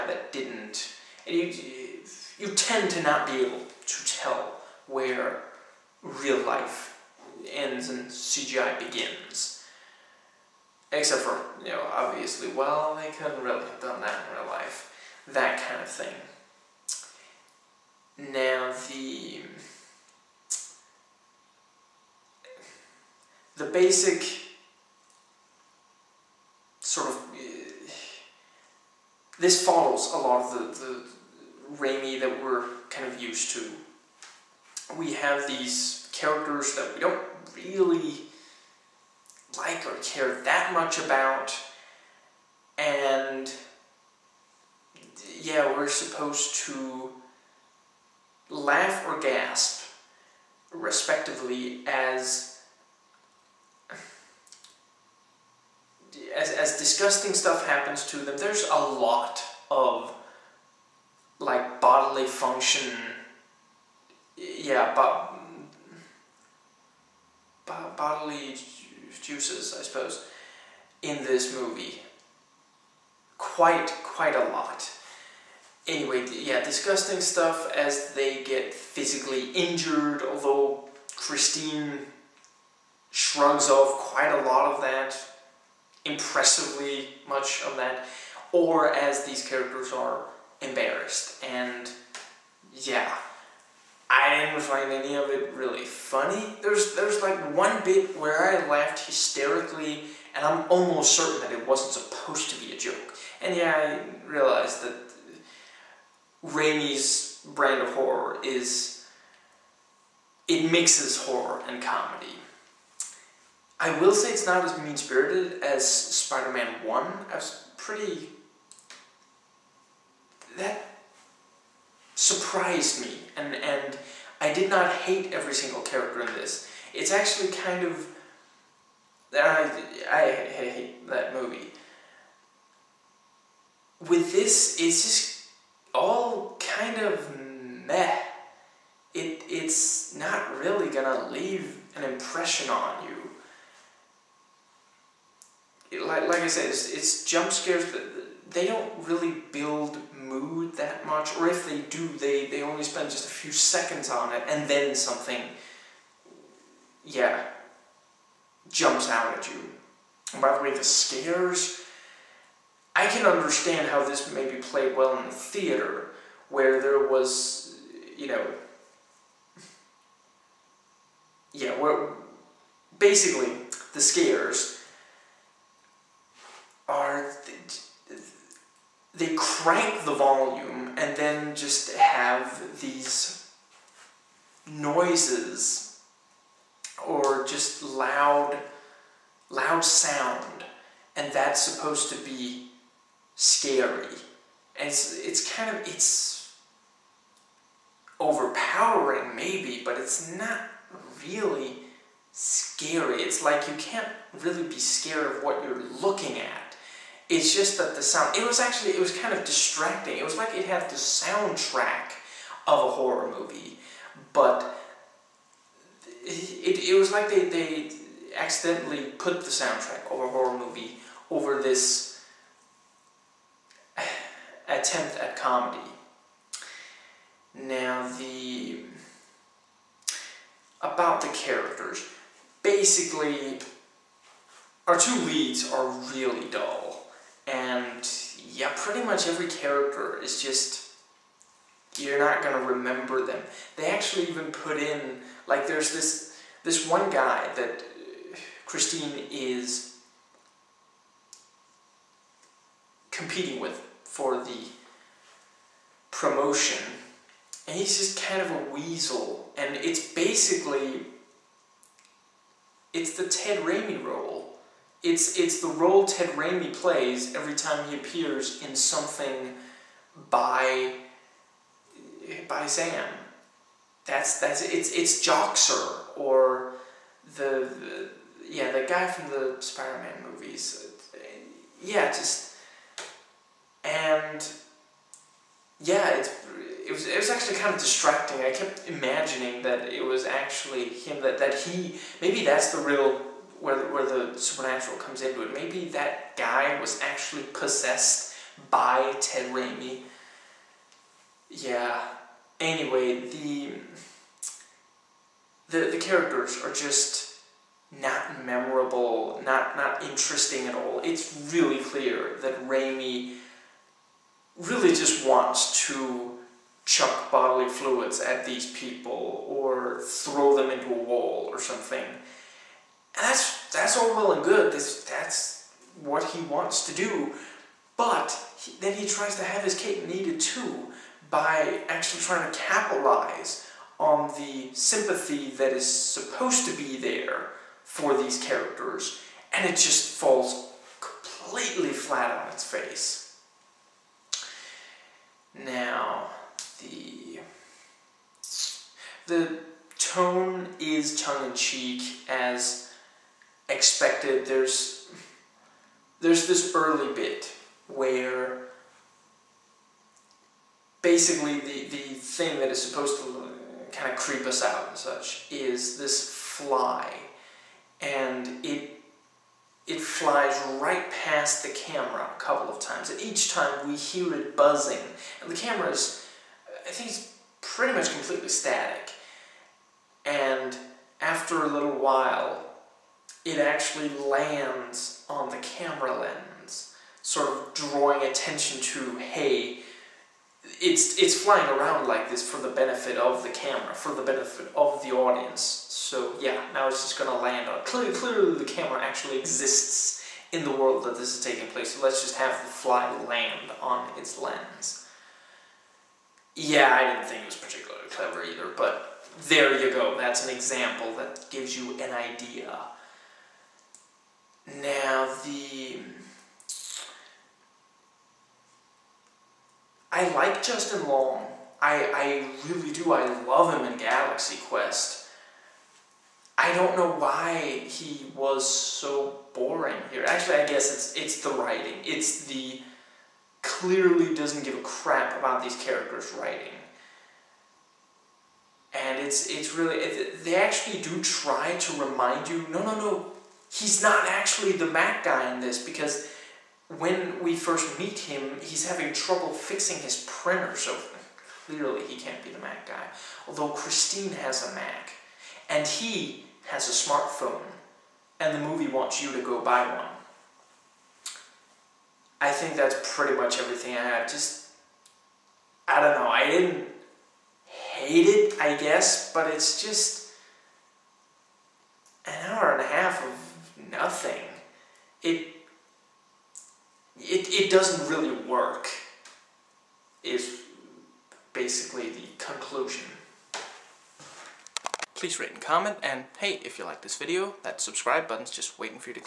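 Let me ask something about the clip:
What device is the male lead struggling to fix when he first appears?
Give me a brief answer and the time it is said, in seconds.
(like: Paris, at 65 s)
His printer, at 450 s.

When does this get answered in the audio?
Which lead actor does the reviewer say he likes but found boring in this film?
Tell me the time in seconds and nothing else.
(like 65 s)
420 s.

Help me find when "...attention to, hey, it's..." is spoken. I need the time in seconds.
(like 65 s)
388 s.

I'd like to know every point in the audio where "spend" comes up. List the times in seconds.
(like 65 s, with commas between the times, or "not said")
152 s.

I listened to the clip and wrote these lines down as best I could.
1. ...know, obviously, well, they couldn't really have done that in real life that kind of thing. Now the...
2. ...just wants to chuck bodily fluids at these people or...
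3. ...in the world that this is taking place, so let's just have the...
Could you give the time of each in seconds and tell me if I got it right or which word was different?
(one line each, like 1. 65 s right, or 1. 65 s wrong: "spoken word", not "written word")
1. 11 s right
2. 314 s right
3. 400 s right.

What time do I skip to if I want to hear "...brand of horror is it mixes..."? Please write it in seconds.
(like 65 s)
107 s.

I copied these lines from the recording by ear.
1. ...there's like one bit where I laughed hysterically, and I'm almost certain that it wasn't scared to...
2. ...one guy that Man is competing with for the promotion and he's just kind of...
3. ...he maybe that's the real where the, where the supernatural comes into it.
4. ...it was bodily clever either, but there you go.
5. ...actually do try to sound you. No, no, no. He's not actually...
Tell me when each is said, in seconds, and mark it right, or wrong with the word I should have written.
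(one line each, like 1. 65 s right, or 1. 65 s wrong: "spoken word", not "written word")
1. 96 s wrong: "supposed", not "scared"
2. 246 s wrong: "Christine", not "Man"
3. 291 s right
4. 407 s wrong: "particularly", not "bodily"
5. 440 s wrong: "remind", not "sound".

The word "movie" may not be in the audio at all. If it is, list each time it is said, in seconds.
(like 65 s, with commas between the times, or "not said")
71 s, 131 s, 213 s, 220 s, 280 s, 458 s.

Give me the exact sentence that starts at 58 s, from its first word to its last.
There's a lot of like bodily function.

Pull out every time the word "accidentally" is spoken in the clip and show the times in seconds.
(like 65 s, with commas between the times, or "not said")
218 s.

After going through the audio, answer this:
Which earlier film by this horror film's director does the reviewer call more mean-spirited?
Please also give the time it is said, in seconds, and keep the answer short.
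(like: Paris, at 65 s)
Spider-Man 1, at 115 s.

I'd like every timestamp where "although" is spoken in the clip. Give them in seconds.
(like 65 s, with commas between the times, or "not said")
80 s, 453 s.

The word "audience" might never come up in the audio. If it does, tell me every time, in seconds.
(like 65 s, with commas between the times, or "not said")
395 s.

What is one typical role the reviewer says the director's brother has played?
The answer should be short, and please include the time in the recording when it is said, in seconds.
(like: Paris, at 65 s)
Joxer, at 275 s.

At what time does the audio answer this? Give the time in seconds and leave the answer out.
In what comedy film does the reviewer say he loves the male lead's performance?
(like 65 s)
423 s.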